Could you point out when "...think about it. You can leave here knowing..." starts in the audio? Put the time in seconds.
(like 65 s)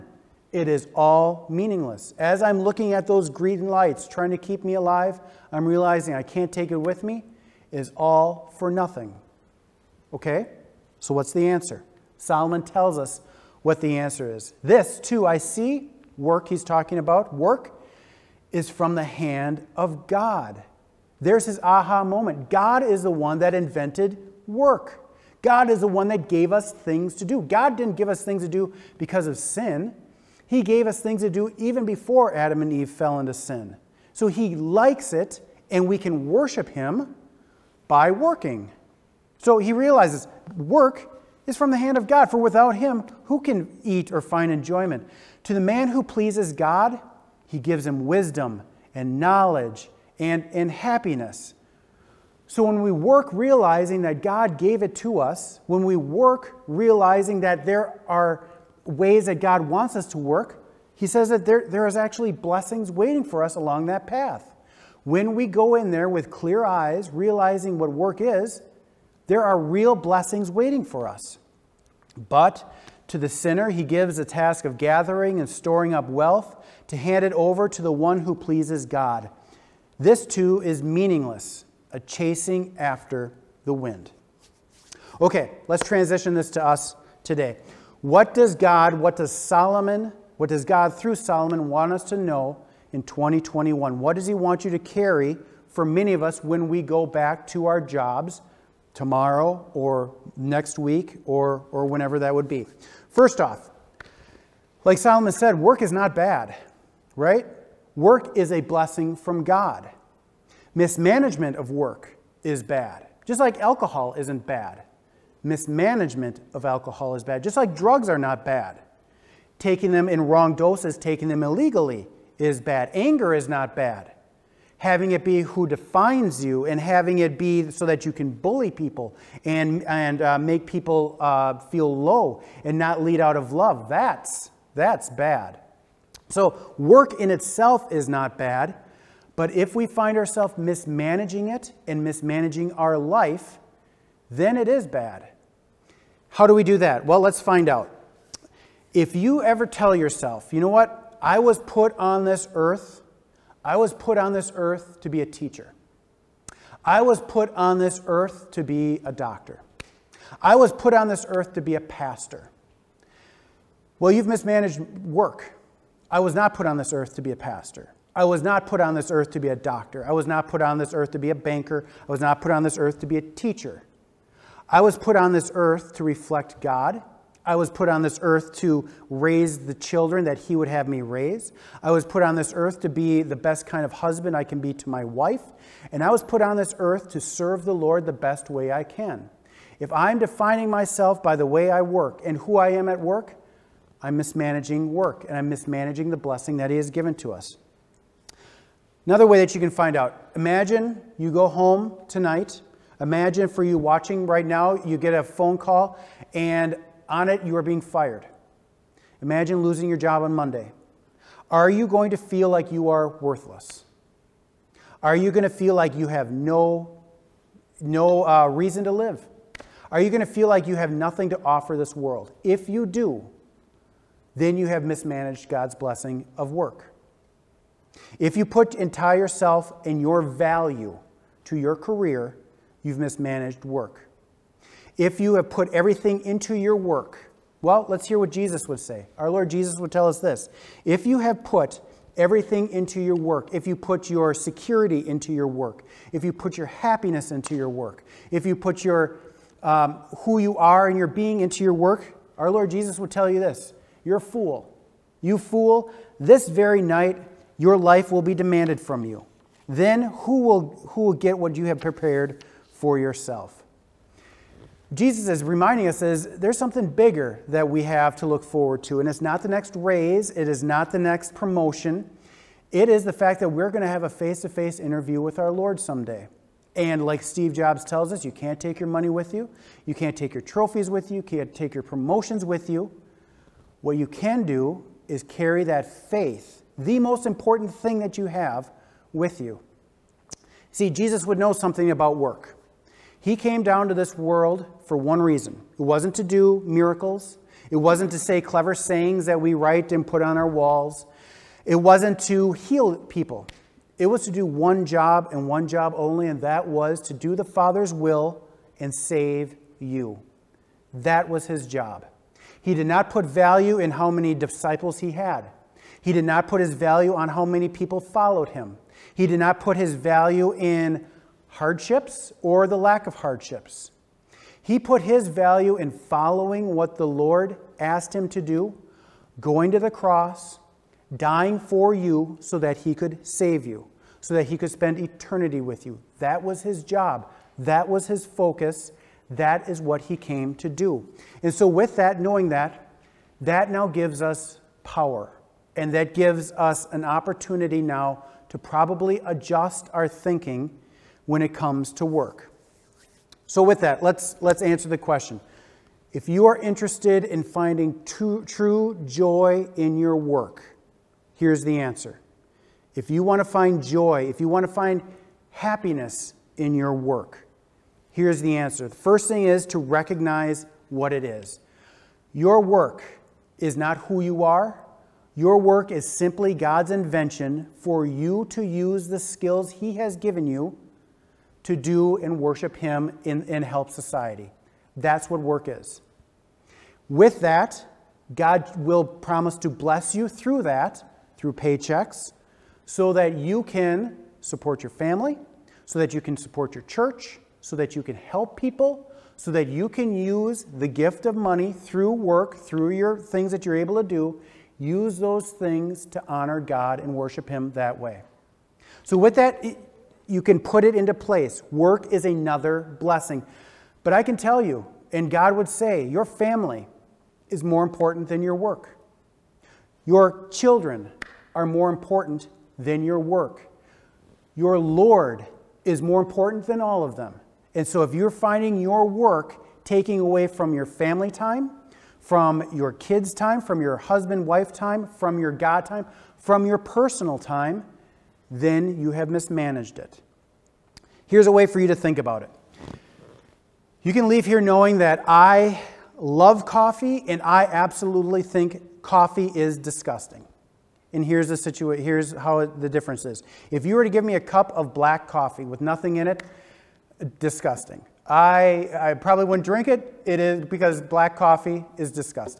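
441 s.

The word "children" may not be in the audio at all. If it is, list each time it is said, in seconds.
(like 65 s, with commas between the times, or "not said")
179 s, 420 s.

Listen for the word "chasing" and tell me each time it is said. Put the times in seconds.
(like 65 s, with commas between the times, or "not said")
81 s.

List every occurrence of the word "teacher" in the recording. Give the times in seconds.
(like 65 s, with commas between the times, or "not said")
155 s, 173 s.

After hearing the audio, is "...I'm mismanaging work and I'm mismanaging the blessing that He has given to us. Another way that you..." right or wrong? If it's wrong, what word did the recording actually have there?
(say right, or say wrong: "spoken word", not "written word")
right.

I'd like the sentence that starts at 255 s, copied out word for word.
You fool, this very night your life will be demanded from you.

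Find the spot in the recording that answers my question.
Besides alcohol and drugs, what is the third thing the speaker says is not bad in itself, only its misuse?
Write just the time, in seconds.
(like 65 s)
122 s.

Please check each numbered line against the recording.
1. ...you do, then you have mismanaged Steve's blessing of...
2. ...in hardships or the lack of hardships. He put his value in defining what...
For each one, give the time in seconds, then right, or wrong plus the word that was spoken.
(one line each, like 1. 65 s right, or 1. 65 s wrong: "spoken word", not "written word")
1. 222 s wrong: "God", not "Steve"
2. 320 s wrong: "following", not "defining".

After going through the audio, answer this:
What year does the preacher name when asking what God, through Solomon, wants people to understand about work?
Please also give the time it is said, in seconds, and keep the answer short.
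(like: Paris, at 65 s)
2021, at 93 s.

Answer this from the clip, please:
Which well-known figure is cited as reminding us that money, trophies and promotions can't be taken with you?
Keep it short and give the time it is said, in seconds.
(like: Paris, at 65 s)
Steve Jobs, at 277 s.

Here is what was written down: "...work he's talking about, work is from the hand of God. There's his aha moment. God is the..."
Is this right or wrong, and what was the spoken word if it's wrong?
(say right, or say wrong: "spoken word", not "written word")
right.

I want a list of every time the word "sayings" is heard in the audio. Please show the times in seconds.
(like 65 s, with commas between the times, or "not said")
298 s.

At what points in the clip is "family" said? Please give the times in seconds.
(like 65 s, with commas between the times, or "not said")
394 s, 416 s, 430 s.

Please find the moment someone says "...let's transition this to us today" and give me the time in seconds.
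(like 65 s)
85 s.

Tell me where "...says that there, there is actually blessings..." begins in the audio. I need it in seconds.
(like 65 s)
61 s.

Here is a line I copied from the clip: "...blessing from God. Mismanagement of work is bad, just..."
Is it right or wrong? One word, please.
right.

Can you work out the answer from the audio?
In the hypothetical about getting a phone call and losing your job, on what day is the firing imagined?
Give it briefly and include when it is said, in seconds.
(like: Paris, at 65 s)
Monday, at 210 s.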